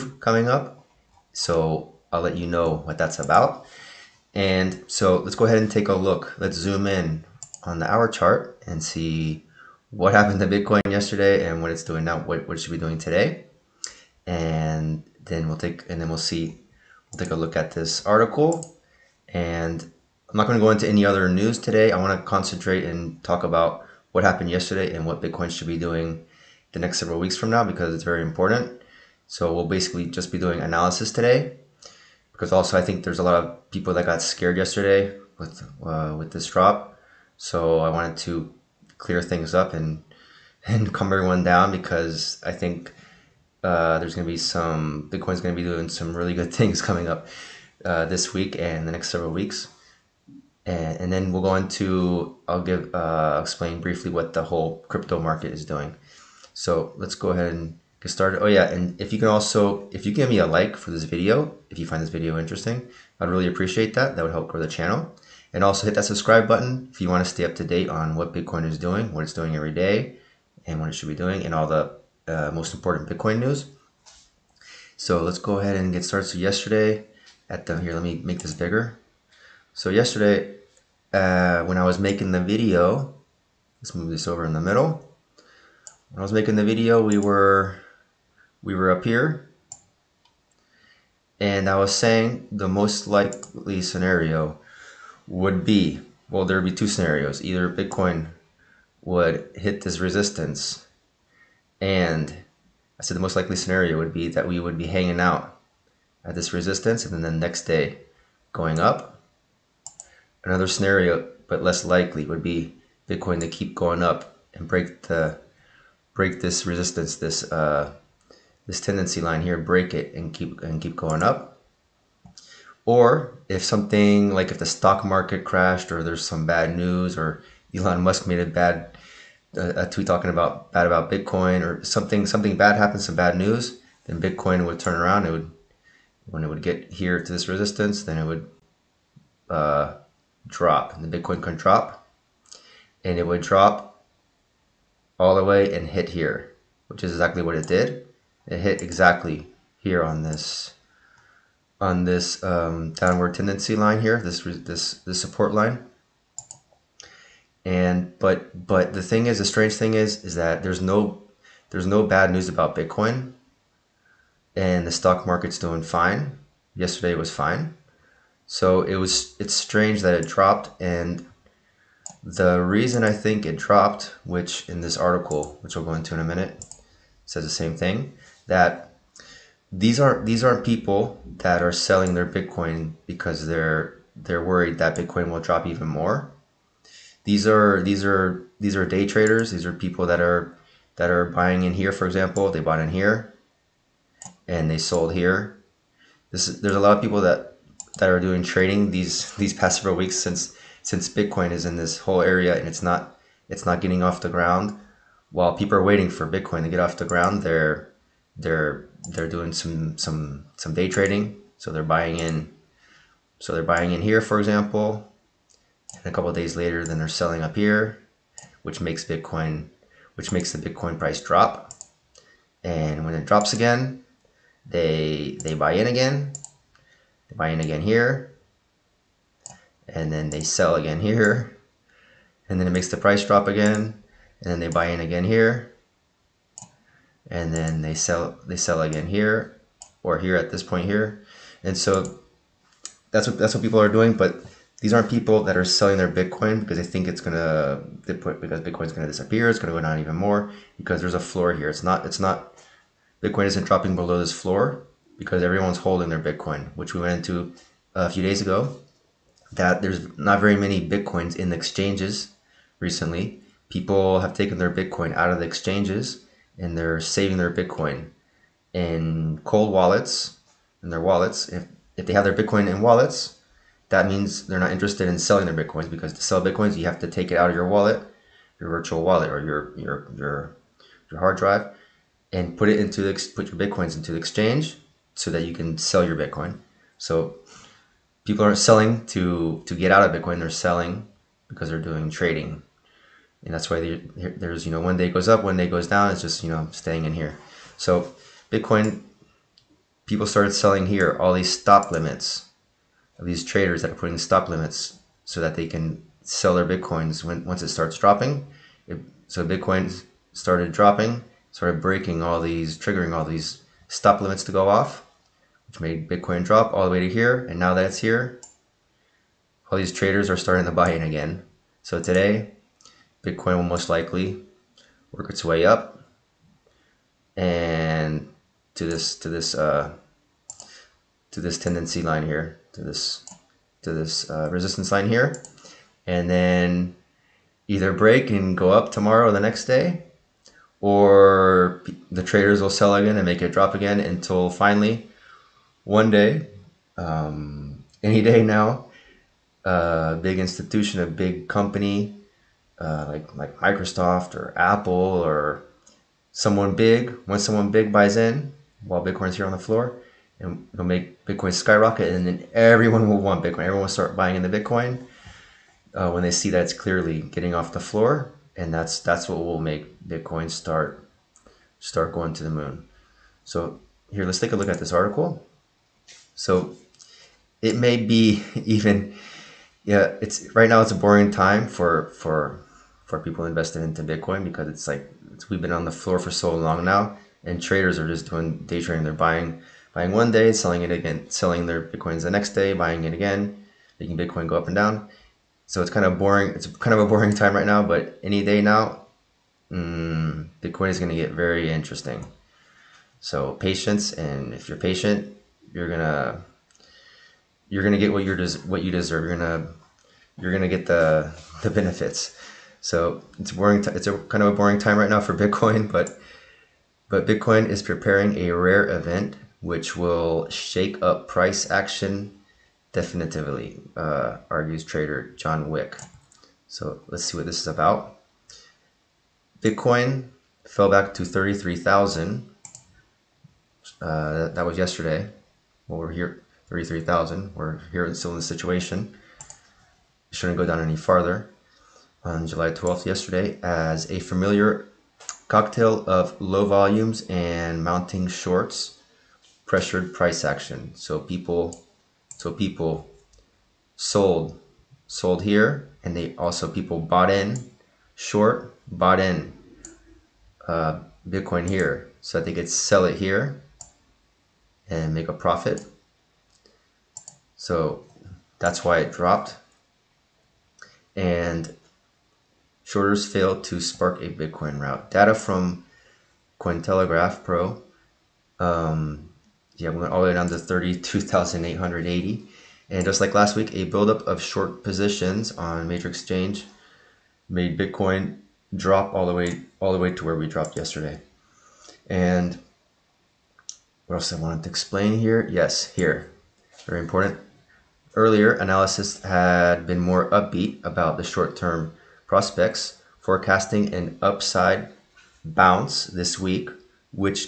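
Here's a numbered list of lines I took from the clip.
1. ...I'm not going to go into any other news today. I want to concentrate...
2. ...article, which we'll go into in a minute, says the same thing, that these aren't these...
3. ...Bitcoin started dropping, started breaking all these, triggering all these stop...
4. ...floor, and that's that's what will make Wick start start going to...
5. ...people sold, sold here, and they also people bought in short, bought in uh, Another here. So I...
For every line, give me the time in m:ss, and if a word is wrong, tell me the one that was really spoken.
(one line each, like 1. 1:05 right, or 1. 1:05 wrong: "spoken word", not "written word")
1. 0:20 right
2. 2:54 right
3. 5:09 right
4. 6:07 wrong: "Bitcoin", not "Wick"
5. 7:32 wrong: "Bitcoin", not "Another".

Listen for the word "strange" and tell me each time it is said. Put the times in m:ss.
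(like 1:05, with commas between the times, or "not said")
2:39, 2:49.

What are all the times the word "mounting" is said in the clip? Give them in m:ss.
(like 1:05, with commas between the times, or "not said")
7:27.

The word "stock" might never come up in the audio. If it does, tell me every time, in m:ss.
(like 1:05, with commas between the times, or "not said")
2:04, 2:44.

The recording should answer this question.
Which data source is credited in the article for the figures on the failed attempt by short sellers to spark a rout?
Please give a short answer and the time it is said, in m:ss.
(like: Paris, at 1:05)
Cointelegraph Pro, at 7:56.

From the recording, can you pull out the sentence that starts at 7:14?
Uh, that was yesterday well, we're here 33,000.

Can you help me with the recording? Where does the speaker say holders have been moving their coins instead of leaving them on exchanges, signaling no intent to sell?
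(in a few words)
cold wallets.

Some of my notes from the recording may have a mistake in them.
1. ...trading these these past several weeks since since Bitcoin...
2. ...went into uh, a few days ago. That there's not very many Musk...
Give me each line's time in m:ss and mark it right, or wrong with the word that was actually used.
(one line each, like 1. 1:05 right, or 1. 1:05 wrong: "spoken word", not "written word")
1. 3:18 right
2. 4:17 wrong: "Bitcoins", not "Musk".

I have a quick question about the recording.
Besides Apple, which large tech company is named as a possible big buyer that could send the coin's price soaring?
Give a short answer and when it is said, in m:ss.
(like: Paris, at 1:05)
Microsoft, at 5:53.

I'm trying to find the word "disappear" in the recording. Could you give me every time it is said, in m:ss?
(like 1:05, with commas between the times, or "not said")
4:09.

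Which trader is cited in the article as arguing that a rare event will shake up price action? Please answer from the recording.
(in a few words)
John Wick.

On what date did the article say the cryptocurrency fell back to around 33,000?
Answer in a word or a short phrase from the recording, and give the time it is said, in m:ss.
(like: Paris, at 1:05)
July 12, at 7:22.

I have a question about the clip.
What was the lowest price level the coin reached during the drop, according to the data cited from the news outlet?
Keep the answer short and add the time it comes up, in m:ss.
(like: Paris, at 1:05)
32,880, at 8:00.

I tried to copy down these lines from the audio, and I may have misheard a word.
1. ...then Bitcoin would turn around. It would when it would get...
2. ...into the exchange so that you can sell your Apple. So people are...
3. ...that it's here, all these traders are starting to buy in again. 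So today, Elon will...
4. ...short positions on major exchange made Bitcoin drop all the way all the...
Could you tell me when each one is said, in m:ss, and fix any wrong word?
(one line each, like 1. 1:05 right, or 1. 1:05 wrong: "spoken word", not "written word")
1. 2:14 right
2. 4:43 wrong: "Bitcoin", not "Apple"
3. 5:17 wrong: "Bitcoin", not "Elon"
4. 8:04 right.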